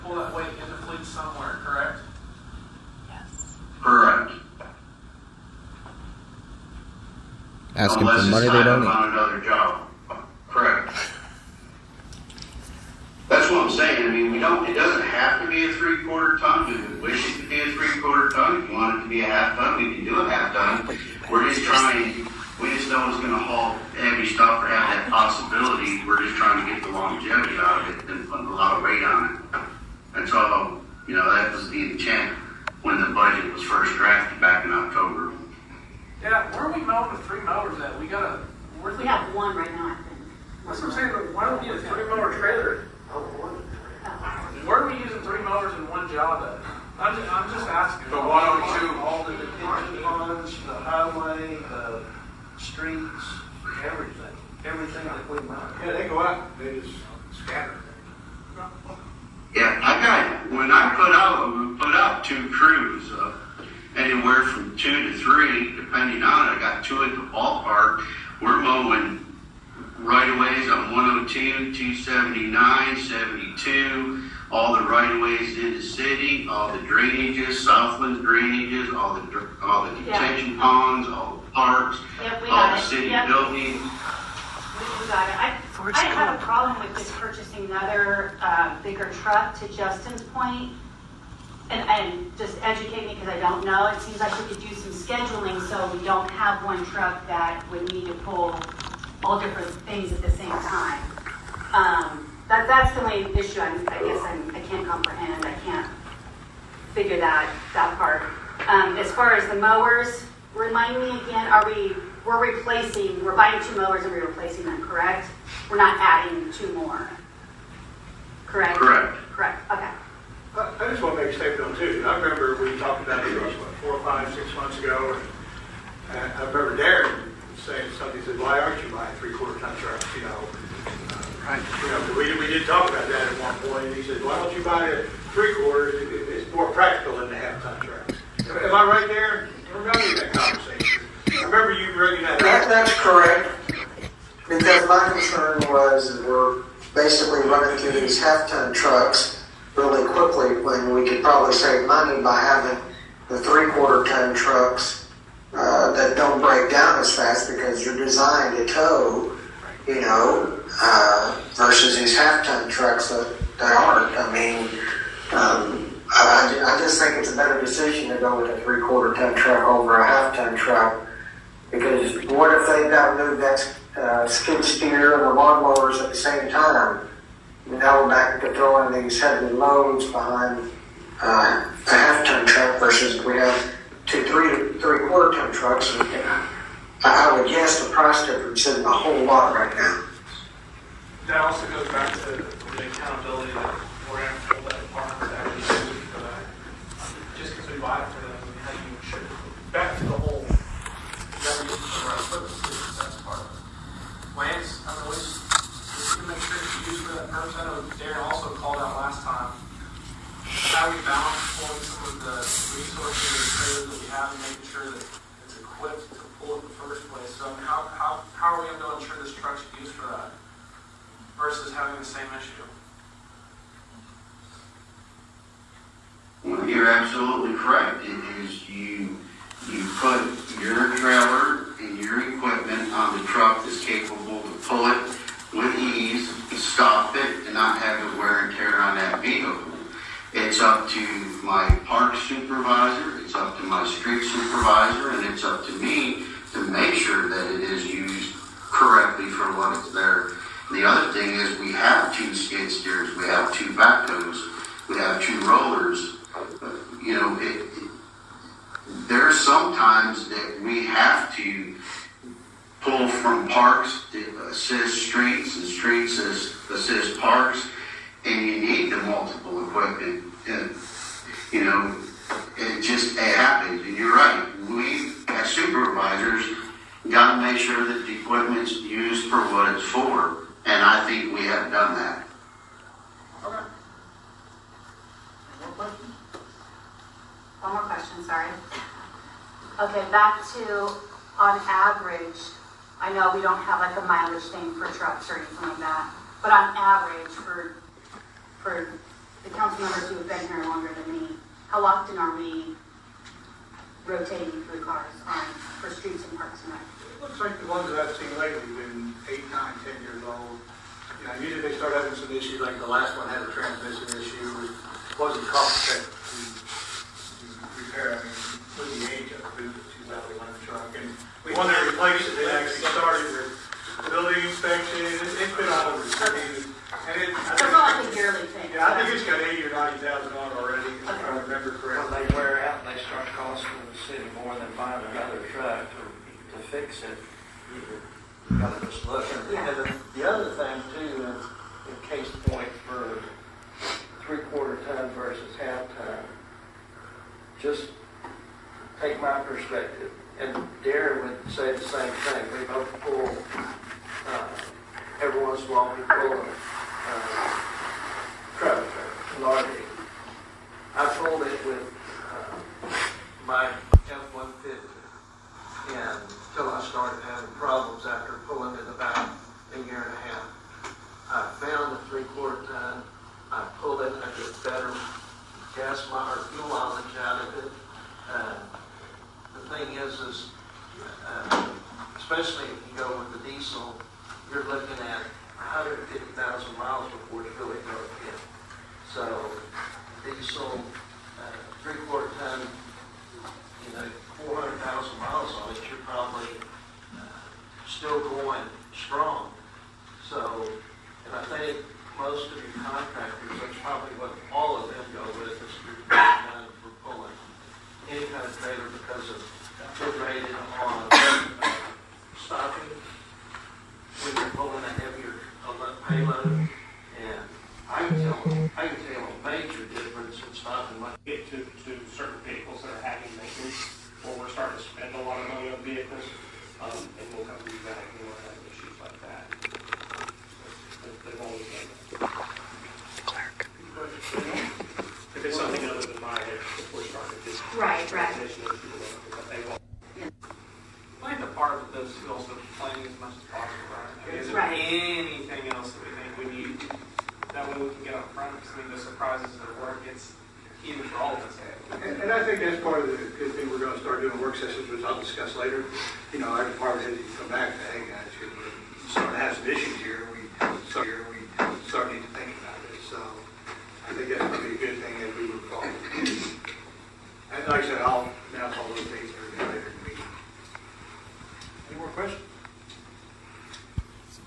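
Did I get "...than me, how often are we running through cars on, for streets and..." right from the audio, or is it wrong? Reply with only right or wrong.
wrong.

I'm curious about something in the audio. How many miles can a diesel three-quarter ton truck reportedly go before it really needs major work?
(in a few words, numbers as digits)
150,000.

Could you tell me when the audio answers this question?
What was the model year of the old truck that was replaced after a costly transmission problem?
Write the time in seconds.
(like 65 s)
319 s.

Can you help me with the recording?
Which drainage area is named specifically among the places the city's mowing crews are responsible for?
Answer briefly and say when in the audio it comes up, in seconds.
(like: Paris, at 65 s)
Southland, at 77 s.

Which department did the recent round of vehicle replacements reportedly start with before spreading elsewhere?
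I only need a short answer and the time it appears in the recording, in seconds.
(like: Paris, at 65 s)
building inspection, at 324 s.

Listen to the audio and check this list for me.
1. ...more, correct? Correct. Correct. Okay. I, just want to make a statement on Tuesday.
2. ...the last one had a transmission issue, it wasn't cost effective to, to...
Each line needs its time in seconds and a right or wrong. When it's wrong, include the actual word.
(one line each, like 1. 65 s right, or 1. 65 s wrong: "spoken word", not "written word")
1. 116 s right
2. 312 s right.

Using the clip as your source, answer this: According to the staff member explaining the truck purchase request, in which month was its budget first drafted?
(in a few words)
October.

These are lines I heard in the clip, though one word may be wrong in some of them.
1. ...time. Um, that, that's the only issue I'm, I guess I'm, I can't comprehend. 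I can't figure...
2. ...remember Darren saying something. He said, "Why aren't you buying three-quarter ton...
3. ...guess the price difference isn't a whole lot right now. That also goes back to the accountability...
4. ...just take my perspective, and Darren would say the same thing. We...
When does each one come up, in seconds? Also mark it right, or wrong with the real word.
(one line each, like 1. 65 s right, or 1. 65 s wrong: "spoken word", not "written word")
1. 100 s right
2. 126 s right
3. 187 s right
4. 347 s right.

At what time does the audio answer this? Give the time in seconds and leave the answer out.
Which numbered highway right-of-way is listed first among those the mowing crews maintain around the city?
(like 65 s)
70 s.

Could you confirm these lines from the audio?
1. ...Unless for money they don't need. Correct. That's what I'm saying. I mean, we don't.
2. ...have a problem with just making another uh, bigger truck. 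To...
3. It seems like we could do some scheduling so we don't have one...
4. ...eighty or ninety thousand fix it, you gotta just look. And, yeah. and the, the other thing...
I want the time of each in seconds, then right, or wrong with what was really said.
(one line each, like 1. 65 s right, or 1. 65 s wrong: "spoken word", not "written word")
1. 8 s right
2. 86 s wrong: "purchasing", not "making"
3. 93 s right
4. 329 s right.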